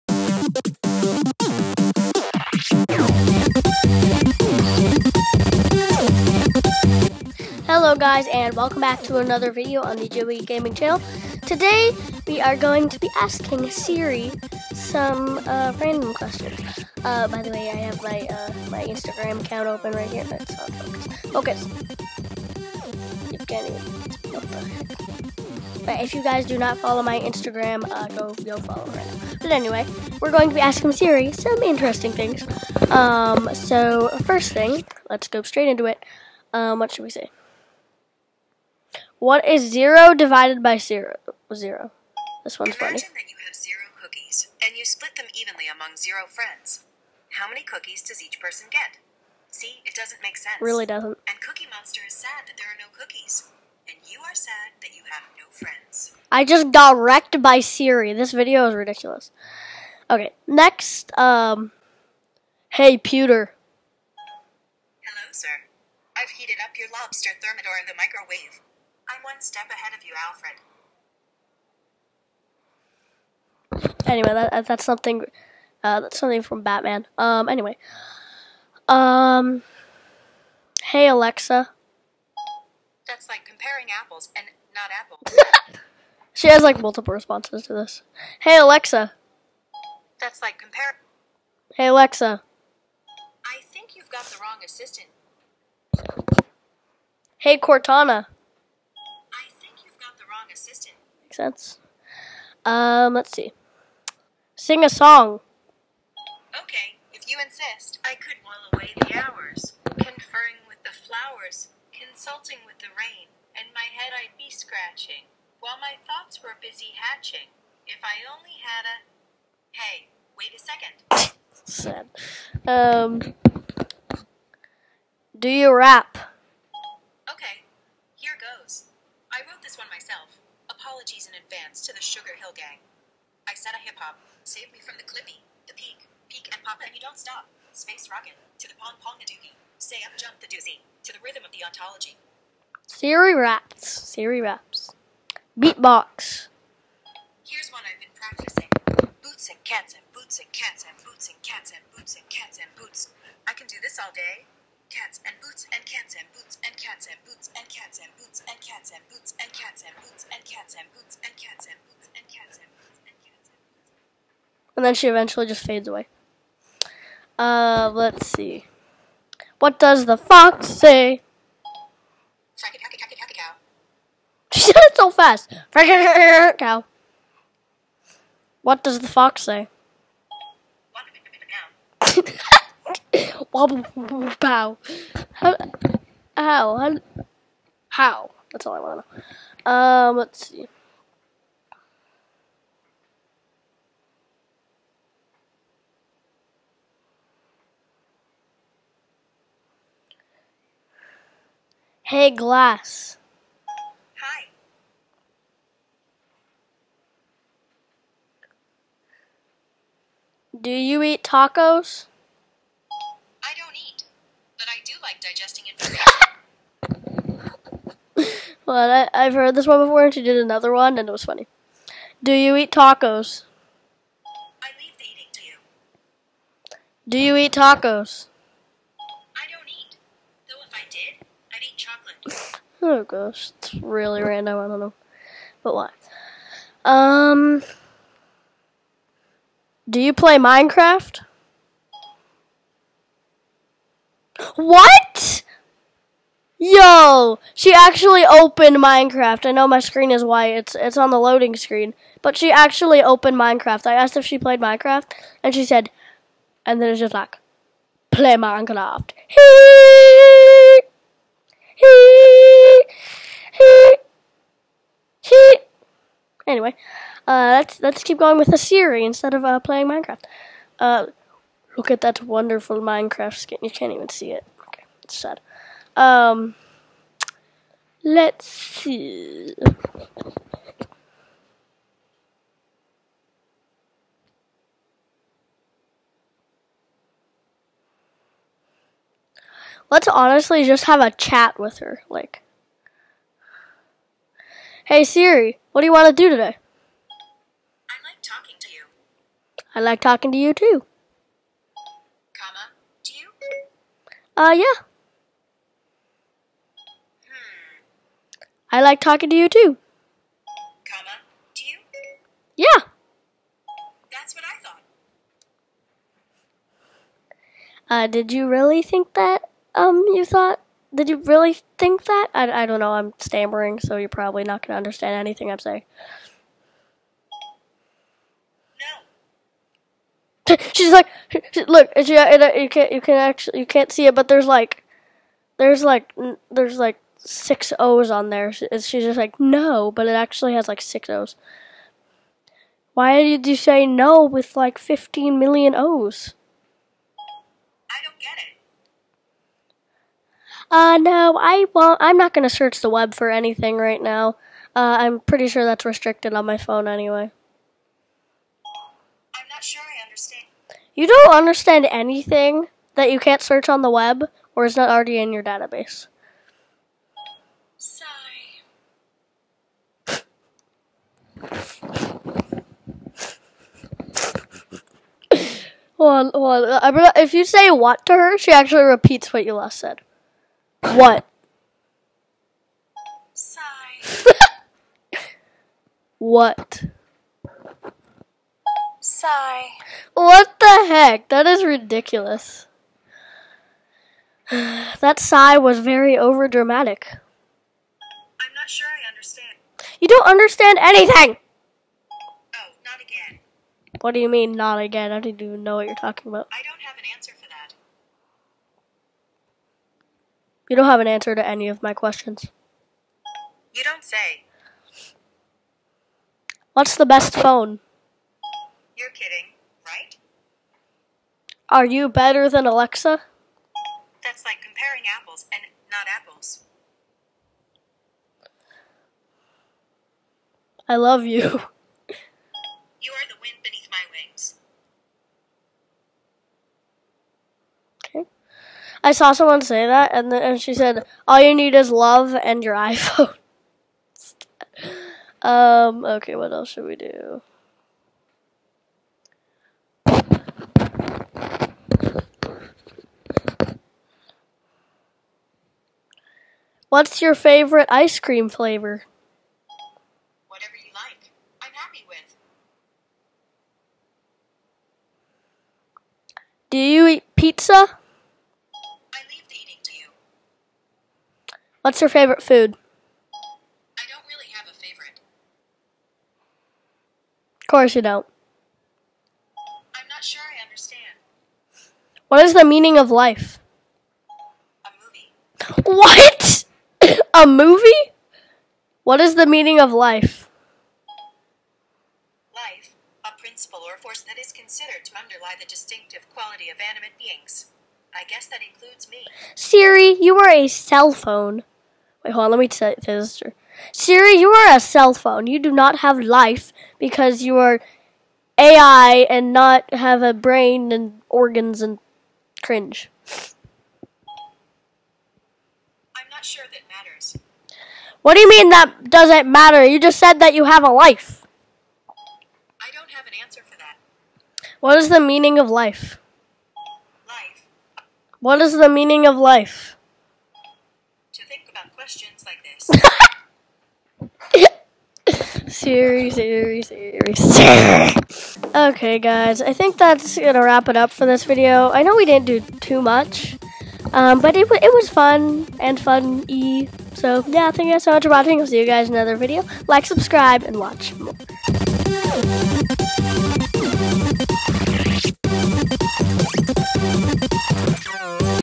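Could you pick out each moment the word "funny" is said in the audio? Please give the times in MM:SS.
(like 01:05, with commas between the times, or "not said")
00:42, 03:41.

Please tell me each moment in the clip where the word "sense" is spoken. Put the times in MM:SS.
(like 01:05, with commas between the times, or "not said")
00:50, 01:41.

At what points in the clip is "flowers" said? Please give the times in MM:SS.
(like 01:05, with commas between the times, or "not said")
01:50.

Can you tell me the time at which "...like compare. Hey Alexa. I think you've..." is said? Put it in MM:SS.
01:30.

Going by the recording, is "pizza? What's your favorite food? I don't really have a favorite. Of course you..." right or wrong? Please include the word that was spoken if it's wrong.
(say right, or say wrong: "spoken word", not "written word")
right.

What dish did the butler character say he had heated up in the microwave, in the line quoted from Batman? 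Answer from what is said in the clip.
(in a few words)
lobster thermidor.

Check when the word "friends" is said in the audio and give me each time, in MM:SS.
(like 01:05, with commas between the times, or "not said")
00:46, 00:55.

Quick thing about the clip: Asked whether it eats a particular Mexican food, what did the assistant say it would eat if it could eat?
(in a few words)
chocolate.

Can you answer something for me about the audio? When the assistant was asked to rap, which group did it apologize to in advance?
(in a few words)
Sugar Hill Gang.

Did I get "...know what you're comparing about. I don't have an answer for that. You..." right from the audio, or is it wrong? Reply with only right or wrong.
wrong.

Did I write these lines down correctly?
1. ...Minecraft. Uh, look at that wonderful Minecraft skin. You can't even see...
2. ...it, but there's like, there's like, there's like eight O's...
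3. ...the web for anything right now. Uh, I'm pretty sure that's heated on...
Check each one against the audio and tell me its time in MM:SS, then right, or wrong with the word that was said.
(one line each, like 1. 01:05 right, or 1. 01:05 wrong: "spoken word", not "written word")
1. 04:29 right
2. 05:34 wrong: "six", not "eight"
3. 05:52 wrong: "restricted", not "heated".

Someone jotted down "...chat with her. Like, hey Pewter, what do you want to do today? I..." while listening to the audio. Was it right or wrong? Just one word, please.
wrong.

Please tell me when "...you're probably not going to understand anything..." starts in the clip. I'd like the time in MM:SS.
05:23.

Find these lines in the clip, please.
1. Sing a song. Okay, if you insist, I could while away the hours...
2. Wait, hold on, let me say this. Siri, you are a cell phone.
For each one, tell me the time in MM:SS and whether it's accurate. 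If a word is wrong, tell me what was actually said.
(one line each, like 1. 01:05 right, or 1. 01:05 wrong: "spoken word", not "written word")
1. 01:44 right
2. 08:22 right.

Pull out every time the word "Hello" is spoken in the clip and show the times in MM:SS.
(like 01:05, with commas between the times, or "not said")
00:07, 01:05.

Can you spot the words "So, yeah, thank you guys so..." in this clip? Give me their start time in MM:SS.
09:07.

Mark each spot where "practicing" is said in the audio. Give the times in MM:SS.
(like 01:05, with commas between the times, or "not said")
02:28.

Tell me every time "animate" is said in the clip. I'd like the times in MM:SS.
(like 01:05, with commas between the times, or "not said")
08:16.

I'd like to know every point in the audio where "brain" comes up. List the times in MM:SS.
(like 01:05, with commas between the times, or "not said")
08:30.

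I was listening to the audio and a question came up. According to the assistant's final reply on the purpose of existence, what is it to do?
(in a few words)
think about questions like this.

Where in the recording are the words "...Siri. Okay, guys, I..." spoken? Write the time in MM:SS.
08:57.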